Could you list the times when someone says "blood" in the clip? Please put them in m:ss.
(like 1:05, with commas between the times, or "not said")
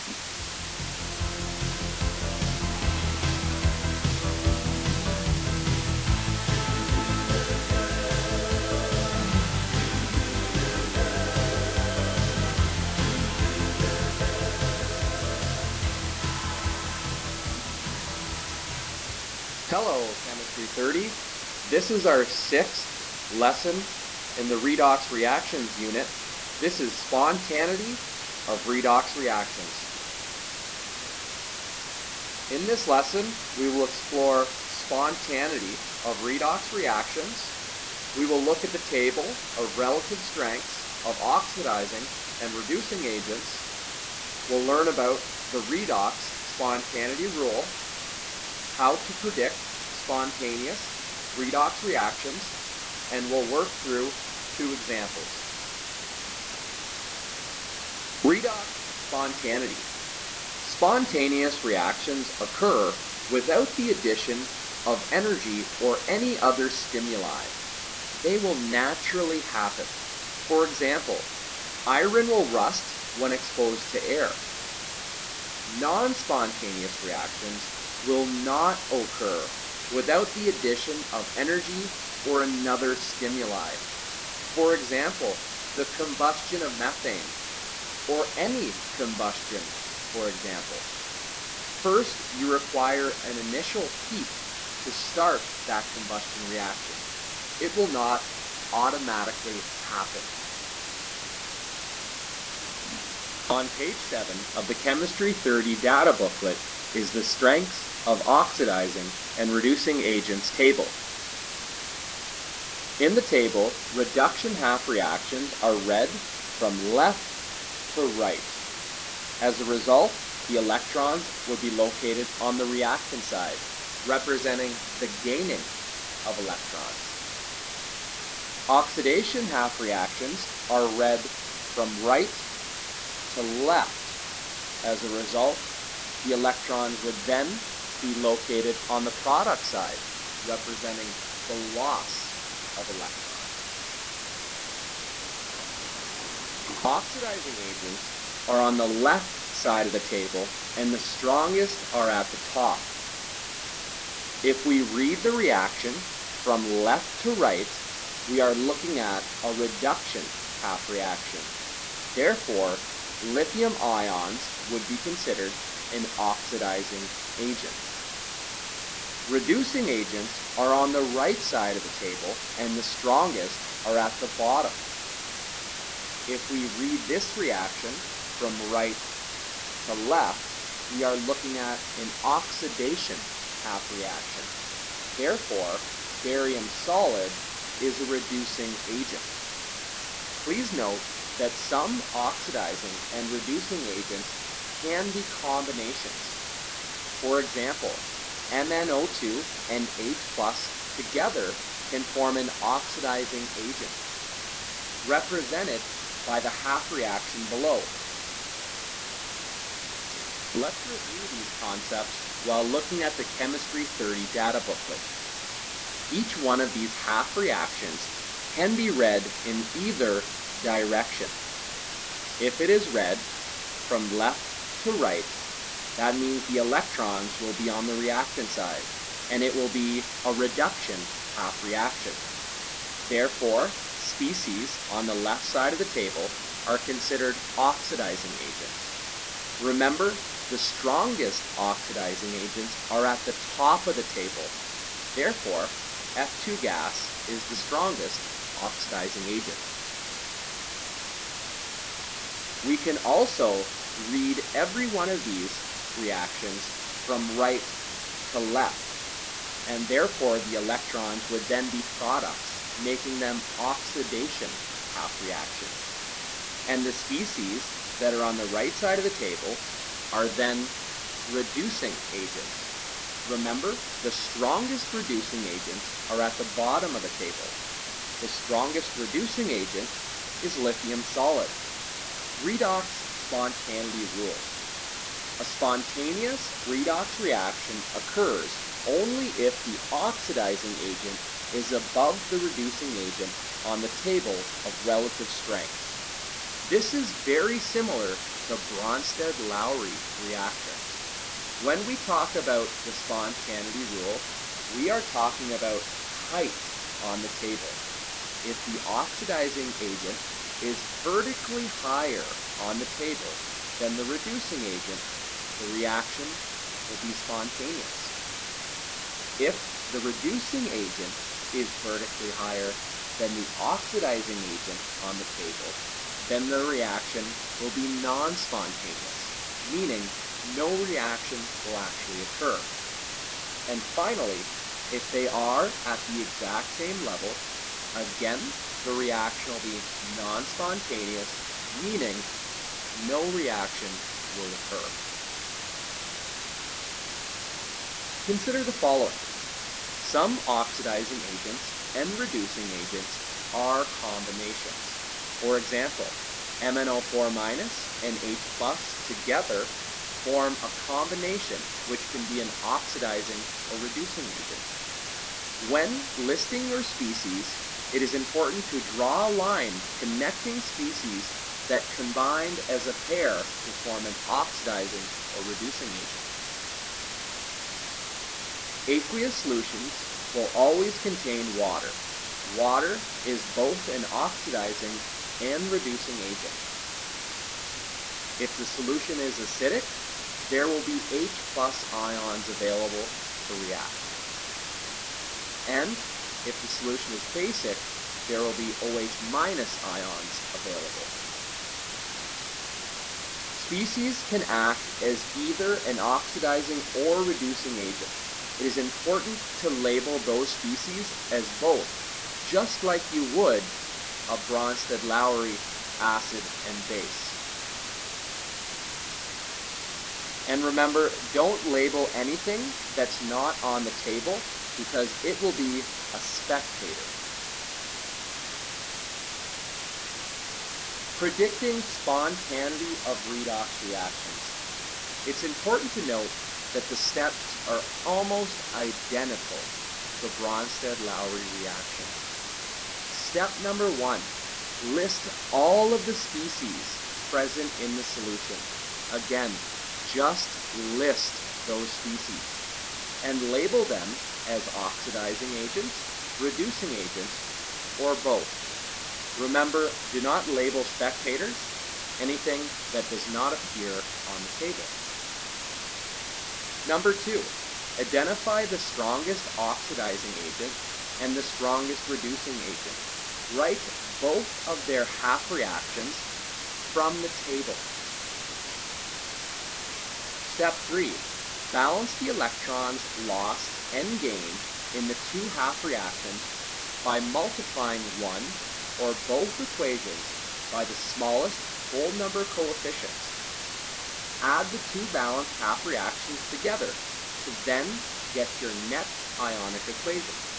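not said.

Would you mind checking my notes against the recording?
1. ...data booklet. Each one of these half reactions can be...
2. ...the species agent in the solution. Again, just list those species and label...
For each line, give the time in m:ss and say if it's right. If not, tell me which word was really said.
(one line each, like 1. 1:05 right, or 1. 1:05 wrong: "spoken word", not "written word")
1. 3:34 right
2. 7:26 wrong: "present", not "agent".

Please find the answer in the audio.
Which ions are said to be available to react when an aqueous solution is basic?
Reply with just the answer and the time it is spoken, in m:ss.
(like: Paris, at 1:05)
OH minus, at 6:38.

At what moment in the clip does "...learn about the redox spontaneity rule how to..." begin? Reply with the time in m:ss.
0:44.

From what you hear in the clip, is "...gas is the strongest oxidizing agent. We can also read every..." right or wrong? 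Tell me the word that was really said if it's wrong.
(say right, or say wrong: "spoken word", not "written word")
right.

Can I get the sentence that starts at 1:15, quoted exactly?
Non-spontaneous reactions will not occur without the addition of energy or another stimuli.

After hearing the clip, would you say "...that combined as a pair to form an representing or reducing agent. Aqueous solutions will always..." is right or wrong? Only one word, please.
wrong.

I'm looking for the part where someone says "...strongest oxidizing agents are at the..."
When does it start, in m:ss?
4:00.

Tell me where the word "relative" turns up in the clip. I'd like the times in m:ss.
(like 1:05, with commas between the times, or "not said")
0:39, 4:54.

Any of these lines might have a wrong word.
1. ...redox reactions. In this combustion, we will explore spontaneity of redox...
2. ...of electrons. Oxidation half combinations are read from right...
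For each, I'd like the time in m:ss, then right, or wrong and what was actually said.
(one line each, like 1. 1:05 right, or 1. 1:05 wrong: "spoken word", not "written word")
1. 0:28 wrong: "lesson", not "combustion"
2. 2:06 wrong: "reactions", not "combinations".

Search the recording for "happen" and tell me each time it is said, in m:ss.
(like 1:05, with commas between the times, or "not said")
1:09, 1:39.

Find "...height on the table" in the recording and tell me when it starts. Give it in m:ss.
5:06.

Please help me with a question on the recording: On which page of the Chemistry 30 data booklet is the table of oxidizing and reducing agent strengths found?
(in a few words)
7.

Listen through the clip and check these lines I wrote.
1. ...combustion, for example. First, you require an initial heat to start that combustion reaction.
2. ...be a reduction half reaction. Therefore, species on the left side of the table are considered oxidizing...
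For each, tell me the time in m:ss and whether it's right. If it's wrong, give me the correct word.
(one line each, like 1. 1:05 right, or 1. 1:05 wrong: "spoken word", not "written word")
1. 1:28 right
2. 3:49 right.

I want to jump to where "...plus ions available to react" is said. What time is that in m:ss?
6:31.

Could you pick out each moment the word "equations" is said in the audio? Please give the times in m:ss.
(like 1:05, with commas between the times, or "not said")
8:09, 8:19.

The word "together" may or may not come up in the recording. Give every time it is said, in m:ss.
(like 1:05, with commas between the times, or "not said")
3:20, 5:59, 8:16.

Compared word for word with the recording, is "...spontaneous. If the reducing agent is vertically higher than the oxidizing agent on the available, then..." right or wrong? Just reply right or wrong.
wrong.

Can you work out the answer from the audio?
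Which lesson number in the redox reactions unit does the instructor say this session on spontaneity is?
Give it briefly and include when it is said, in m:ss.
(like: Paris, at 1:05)
Sixth, at 0:22.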